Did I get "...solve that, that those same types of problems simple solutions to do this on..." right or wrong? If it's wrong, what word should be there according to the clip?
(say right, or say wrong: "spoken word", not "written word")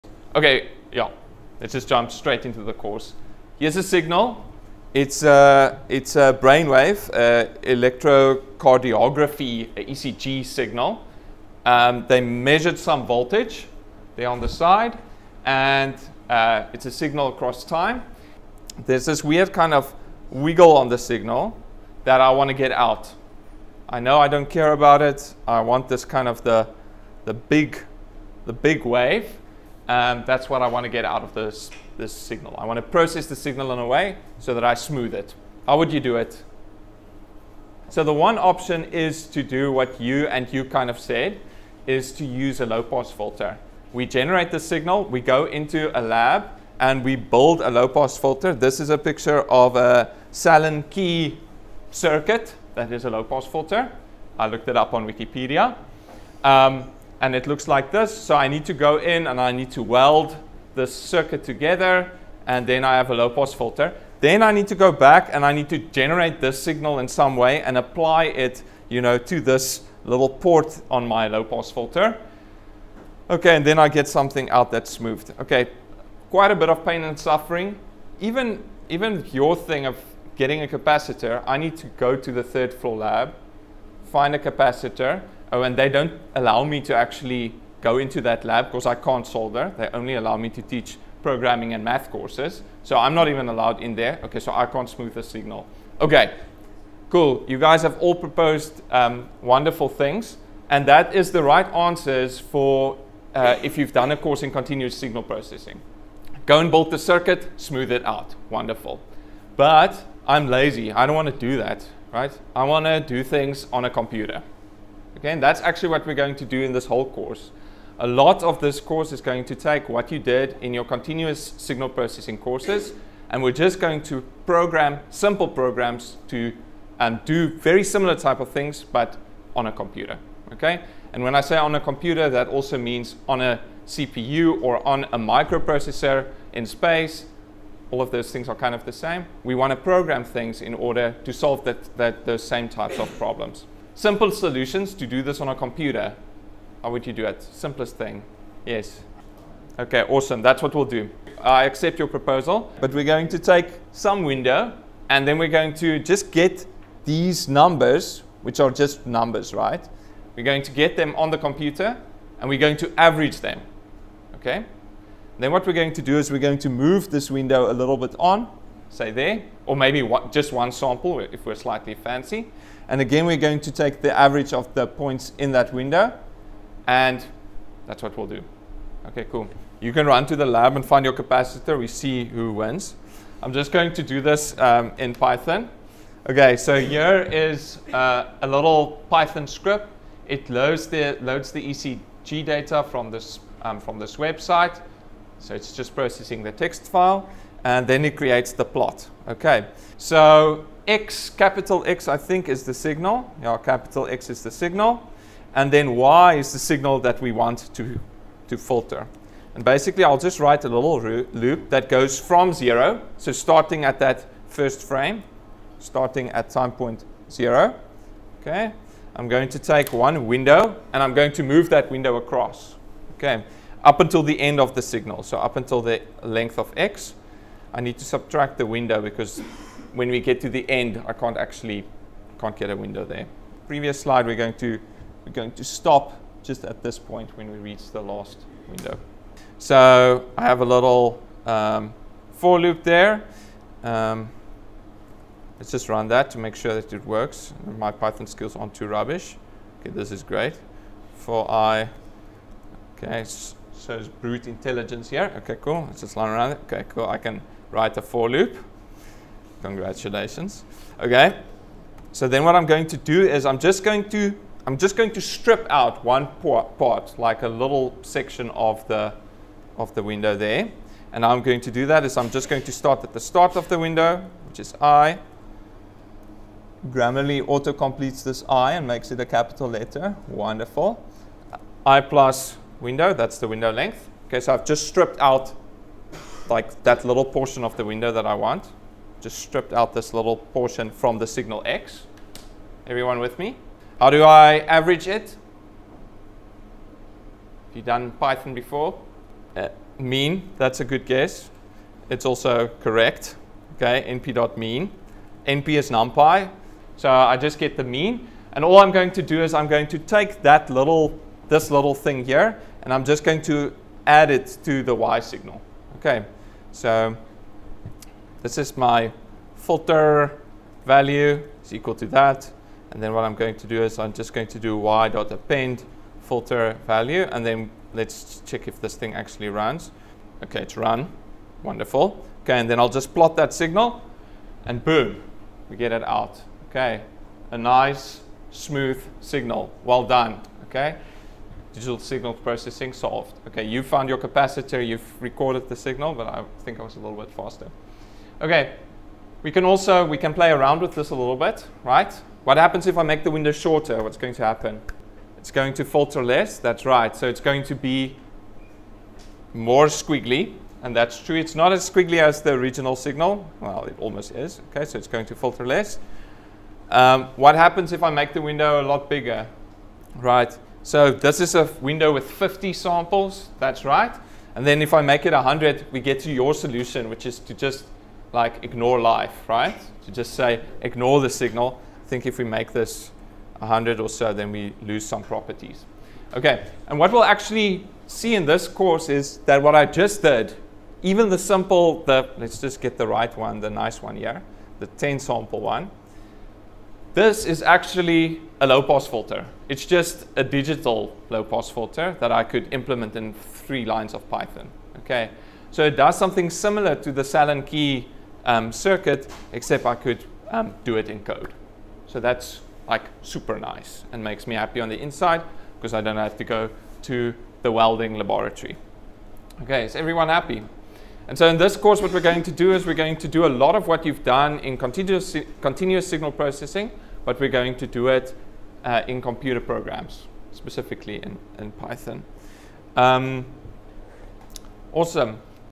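right.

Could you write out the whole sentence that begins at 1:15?
Okay, quite a bit of pain and suffering.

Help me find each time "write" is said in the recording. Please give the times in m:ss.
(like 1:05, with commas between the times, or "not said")
3:30, 4:17.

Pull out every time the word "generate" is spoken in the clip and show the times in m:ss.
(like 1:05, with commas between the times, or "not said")
0:44, 1:05.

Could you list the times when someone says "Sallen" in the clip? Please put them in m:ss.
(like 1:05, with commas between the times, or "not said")
0:50, 6:47.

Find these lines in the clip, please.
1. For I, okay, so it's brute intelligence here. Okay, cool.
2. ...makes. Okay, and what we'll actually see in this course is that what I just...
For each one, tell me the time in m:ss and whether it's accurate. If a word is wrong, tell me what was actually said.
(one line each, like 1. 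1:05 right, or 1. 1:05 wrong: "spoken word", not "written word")
1. 4:11 right
2. 6:25 wrong: "properties", not "makes".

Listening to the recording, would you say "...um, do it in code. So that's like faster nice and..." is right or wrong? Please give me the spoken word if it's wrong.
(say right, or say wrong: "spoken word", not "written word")
wrong: "super", not "faster".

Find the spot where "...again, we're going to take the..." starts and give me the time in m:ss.
2:53.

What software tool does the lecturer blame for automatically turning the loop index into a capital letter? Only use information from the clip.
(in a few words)
Grammarly.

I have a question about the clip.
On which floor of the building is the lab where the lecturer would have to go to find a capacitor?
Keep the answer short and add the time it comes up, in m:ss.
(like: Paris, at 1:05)
Third floor, at 1:22.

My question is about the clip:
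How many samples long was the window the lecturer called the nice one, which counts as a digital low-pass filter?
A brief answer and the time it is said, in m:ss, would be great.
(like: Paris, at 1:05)
10, at 6:34.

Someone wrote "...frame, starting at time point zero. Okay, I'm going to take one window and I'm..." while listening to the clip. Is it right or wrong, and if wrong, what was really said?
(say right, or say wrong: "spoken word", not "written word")
right.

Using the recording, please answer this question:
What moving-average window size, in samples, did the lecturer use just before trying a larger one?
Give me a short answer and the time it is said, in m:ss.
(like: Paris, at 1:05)
50, at 6:12.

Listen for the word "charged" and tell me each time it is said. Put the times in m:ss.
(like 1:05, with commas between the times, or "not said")
not said.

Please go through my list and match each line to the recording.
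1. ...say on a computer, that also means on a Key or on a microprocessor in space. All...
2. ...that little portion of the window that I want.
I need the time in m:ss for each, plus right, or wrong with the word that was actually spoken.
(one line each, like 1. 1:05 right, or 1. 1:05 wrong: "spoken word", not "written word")
1. 2:11 wrong: "CPU", not "Key"
2. 4:46 right.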